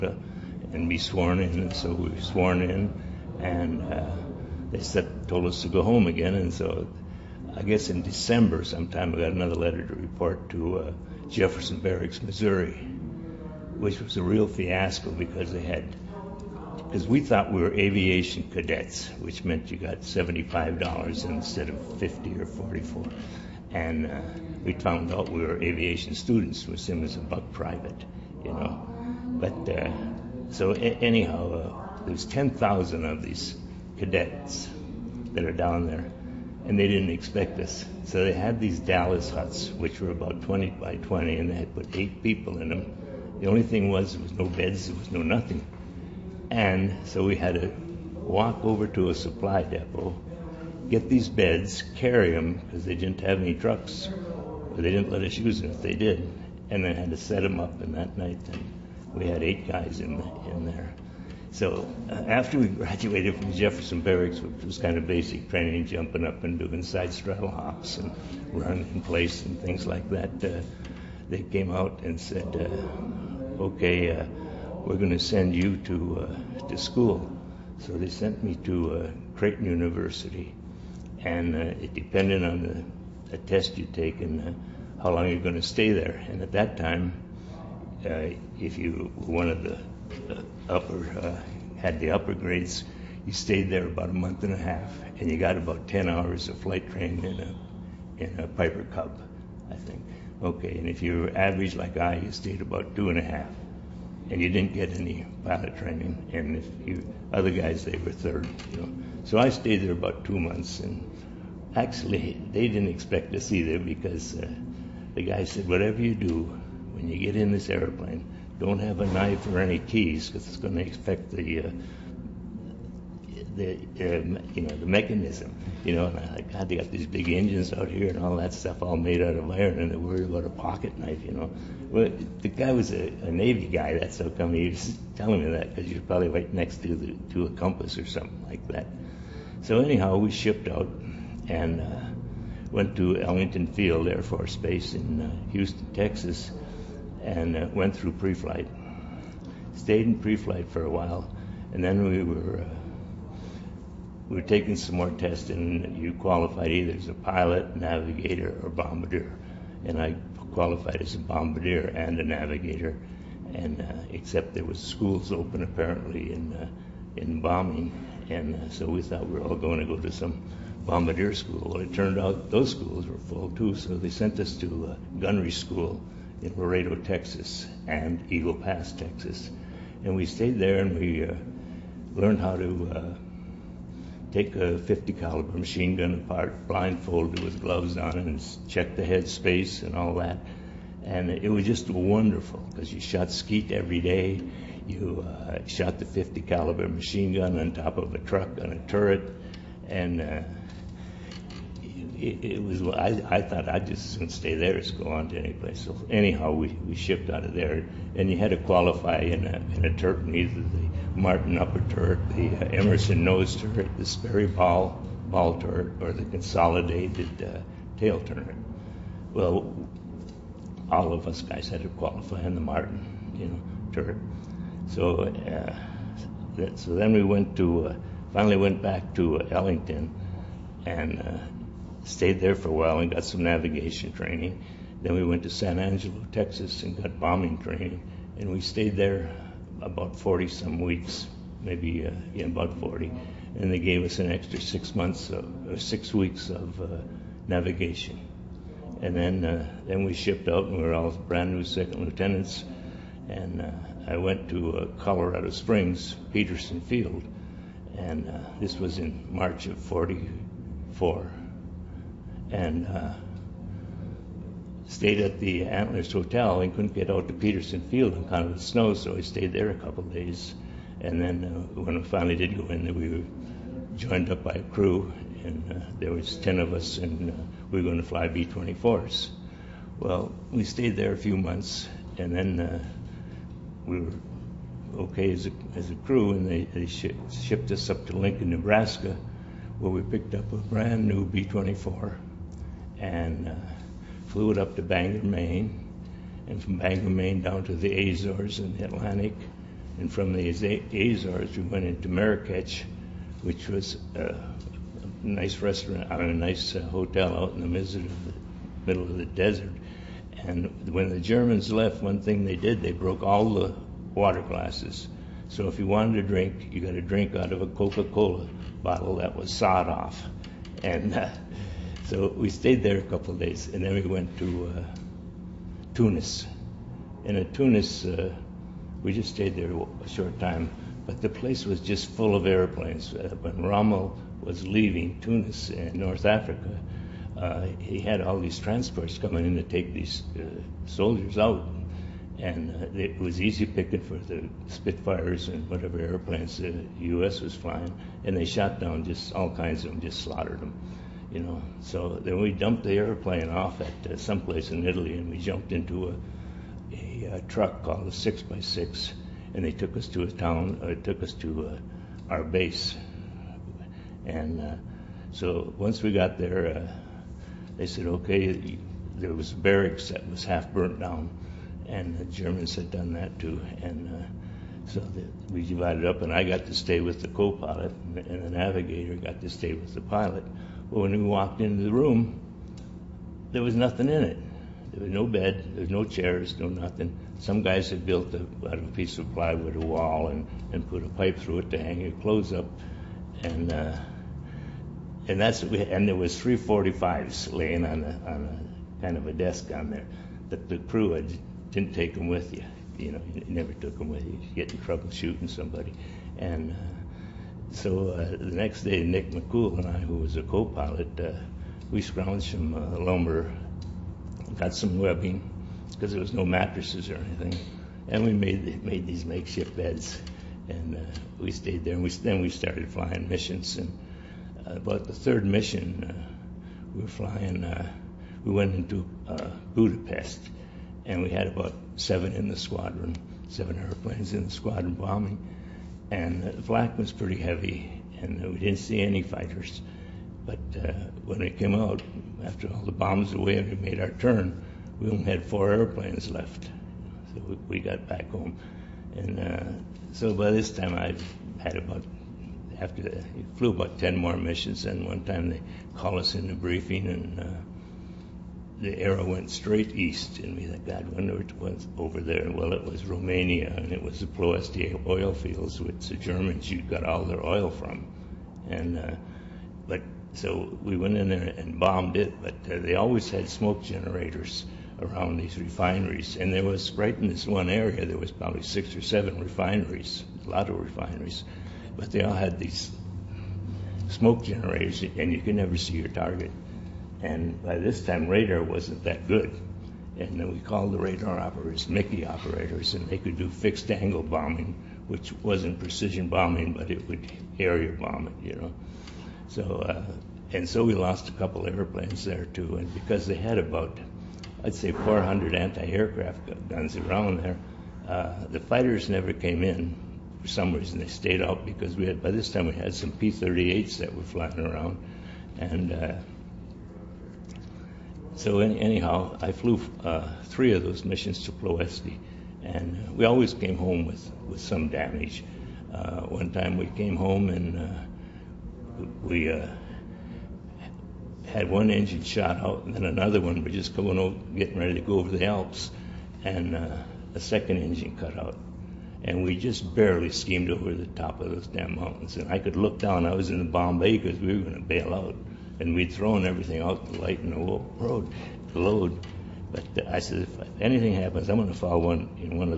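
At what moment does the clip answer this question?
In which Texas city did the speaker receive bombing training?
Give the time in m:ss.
3:55.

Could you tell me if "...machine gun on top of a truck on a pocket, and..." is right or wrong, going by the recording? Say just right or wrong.
wrong.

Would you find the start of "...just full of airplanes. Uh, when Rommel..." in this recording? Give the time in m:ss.
5:31.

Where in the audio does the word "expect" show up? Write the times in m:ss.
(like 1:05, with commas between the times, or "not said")
0:37, 1:52.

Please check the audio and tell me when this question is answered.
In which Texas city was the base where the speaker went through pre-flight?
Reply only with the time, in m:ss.
2:25.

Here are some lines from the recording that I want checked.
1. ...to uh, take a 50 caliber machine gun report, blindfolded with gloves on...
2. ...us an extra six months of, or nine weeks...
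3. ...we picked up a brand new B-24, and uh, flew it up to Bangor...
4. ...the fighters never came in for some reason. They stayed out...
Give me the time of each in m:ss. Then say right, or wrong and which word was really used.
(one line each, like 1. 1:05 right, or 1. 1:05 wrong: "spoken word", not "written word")
1. 3:02 wrong: "apart", not "report"
2. 4:04 wrong: "six", not "nine"
3. 4:49 right
4. 8:28 right.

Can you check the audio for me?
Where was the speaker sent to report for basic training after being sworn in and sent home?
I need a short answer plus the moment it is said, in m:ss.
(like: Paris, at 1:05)
Jefferson Barracks, Missouri, at 0:11.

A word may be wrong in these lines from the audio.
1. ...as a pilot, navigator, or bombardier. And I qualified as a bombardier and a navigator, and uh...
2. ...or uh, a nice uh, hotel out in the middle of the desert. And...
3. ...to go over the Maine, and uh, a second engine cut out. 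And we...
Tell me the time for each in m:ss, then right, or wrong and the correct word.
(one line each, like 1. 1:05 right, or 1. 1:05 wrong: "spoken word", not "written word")
1. 2:36 right
2. 5:06 right
3. 8:54 wrong: "Alps", not "Maine".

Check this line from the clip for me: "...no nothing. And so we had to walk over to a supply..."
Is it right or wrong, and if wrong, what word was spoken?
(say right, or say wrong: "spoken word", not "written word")
right.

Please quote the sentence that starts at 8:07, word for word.
And by this time, radar wasn't that good.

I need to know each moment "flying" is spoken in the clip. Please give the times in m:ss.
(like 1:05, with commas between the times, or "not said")
5:47, 7:02, 7:07, 8:34.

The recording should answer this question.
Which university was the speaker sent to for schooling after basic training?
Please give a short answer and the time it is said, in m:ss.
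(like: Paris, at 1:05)
Creighton University, at 1:19.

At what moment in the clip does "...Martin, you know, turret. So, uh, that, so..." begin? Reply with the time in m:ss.
3:42.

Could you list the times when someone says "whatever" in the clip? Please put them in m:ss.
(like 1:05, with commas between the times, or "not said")
1:55, 5:45.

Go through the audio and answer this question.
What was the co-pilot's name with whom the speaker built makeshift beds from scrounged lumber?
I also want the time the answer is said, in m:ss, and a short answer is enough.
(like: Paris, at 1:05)
Nick McCool, at 6:49.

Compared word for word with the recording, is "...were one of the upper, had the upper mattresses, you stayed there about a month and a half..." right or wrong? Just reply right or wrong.
wrong.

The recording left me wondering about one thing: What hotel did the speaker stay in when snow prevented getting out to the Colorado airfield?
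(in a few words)
Antlers Hotel.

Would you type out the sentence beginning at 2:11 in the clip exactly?
You know, well, the guy was a, a Navy guy.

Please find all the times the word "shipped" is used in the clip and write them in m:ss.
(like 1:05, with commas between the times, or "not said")
2:20, 3:26, 4:10, 4:47.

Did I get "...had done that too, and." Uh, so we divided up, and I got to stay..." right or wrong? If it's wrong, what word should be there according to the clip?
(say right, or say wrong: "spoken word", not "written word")
right.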